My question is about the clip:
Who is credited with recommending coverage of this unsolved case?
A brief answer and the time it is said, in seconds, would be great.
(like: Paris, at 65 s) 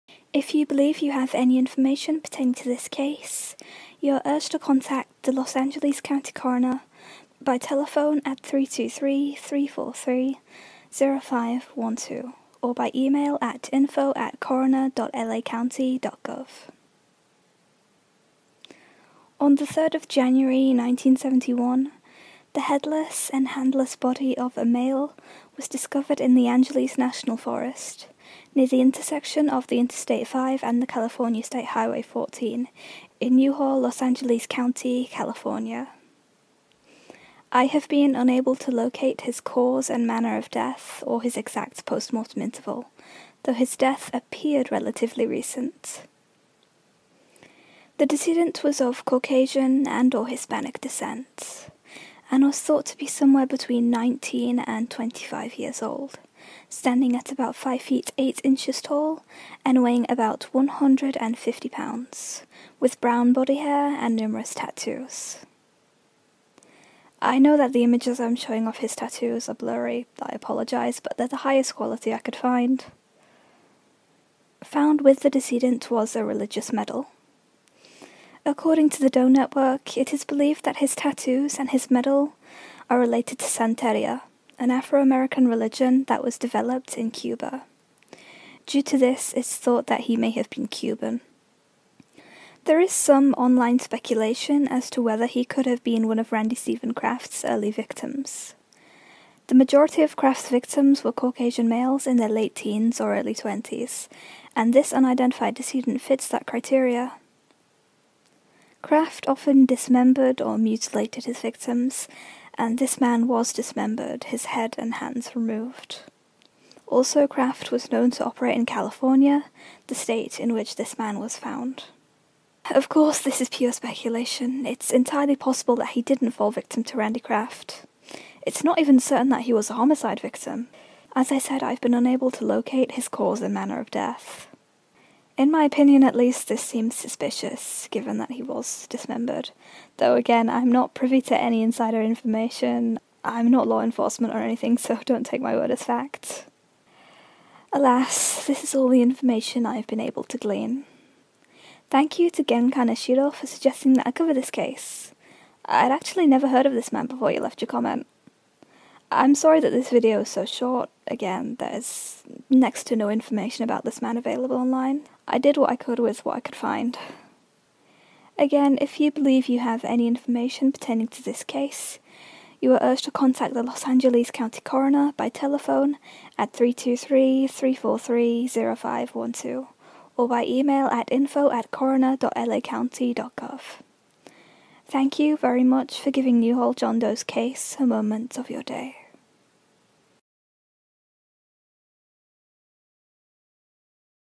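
Gen Kaneshiro, at 152 s.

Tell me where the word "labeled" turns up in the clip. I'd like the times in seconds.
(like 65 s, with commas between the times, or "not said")
not said.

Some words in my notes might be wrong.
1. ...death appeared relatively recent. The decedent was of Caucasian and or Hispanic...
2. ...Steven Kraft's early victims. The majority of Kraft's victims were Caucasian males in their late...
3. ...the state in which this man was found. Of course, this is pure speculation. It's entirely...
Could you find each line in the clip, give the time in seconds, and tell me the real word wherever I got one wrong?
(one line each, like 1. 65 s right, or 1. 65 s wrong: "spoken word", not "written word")
1. 43 s right
2. 96 s right
3. 119 s right.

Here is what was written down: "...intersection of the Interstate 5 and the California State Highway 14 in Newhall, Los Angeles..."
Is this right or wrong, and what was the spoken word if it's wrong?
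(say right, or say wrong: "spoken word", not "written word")
right.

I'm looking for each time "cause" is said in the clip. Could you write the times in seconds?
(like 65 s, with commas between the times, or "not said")
39 s, 133 s.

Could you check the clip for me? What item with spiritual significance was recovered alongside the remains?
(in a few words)
A religious medal.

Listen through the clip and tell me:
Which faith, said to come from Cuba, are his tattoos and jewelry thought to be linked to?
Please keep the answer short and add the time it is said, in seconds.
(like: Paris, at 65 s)
Santeria, at 83 s.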